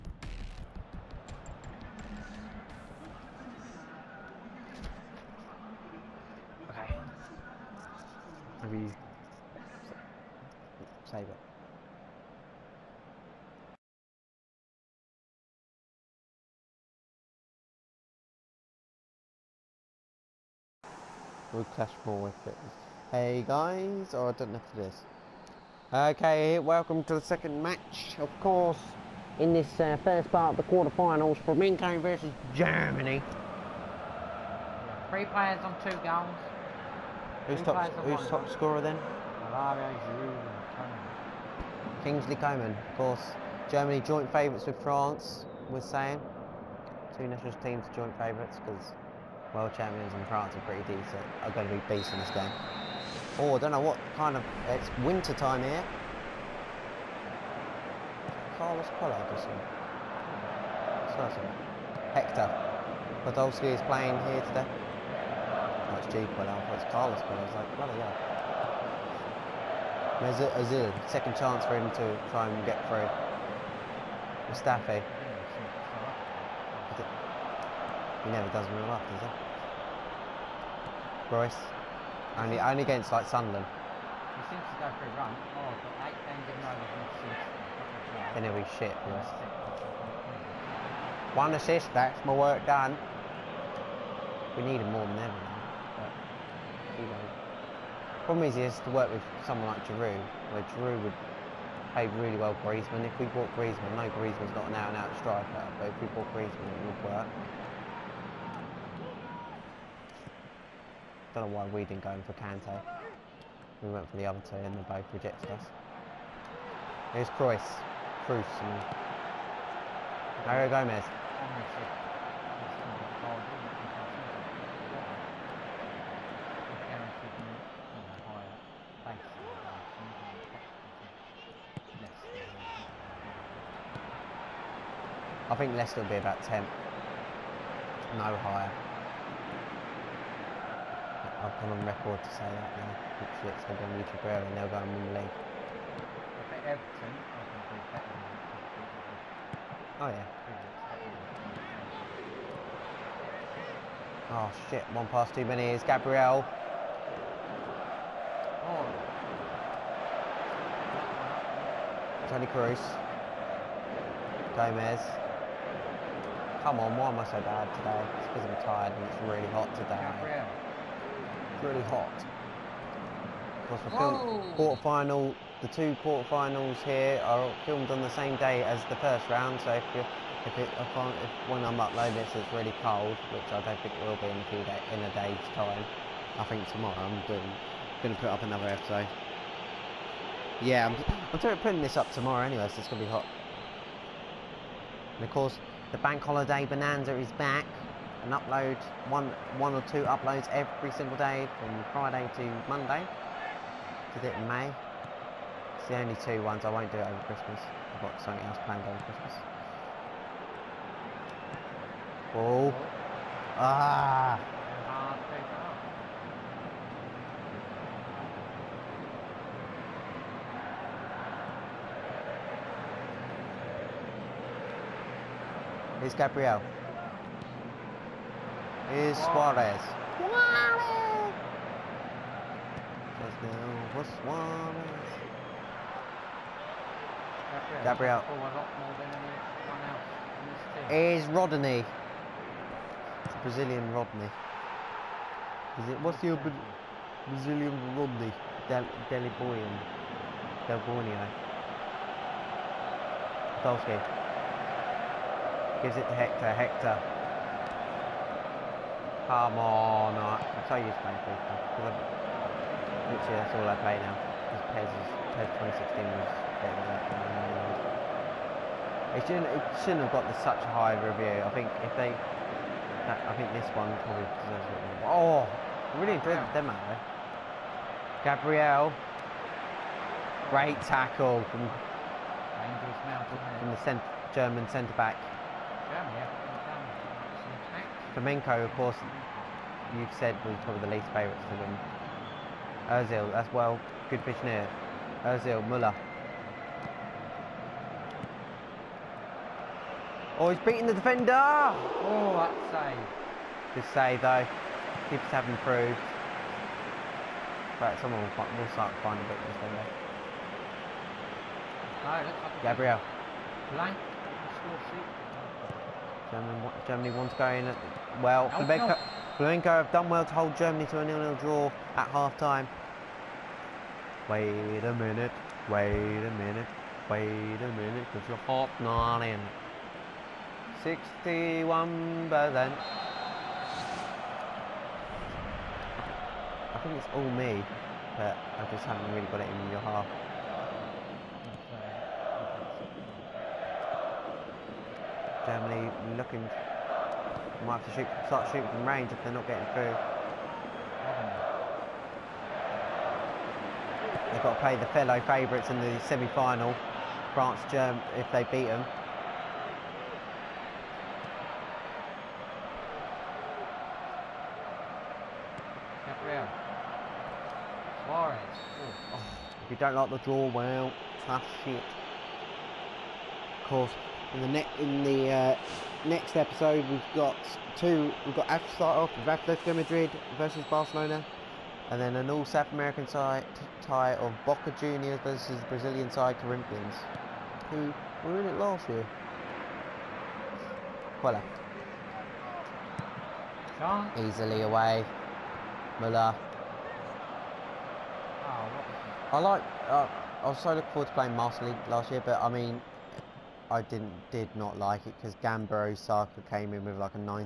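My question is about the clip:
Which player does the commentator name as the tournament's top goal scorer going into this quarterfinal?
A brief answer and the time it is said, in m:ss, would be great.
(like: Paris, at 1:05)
Kingsley Coman, at 0:42.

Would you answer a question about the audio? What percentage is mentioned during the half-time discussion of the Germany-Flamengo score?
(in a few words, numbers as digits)
61%.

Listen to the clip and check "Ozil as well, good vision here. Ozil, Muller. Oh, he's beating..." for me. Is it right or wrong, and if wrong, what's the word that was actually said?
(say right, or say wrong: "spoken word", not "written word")
right.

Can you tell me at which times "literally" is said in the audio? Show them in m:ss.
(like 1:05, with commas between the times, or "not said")
4:23.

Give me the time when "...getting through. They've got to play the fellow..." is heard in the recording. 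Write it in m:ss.
5:49.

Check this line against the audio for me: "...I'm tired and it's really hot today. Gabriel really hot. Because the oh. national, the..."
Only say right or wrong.
wrong.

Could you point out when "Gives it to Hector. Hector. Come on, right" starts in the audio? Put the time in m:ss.
4:15.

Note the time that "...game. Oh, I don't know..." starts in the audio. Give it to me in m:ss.
0:52.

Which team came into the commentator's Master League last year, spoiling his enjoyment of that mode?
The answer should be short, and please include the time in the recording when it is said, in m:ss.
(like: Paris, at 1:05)
Gamba Osaka, at 6:45.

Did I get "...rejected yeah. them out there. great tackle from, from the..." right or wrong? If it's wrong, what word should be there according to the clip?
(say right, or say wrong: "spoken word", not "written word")
wrong: "enjoyed", not "rejected".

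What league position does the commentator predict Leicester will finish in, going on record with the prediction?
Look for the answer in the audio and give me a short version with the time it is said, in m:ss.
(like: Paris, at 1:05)
10, at 2:16.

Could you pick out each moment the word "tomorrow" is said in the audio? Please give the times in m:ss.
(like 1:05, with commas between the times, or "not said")
3:06, 3:12.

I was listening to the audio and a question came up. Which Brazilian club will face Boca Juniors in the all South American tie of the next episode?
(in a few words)
Corinthians.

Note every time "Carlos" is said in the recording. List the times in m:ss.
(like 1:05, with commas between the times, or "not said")
0:58, 1:06.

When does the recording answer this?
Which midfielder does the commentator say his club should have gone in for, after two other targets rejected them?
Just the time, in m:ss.
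1:52.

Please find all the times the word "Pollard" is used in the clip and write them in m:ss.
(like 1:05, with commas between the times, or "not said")
0:59, 1:06.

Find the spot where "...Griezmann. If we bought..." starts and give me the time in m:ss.
1:42.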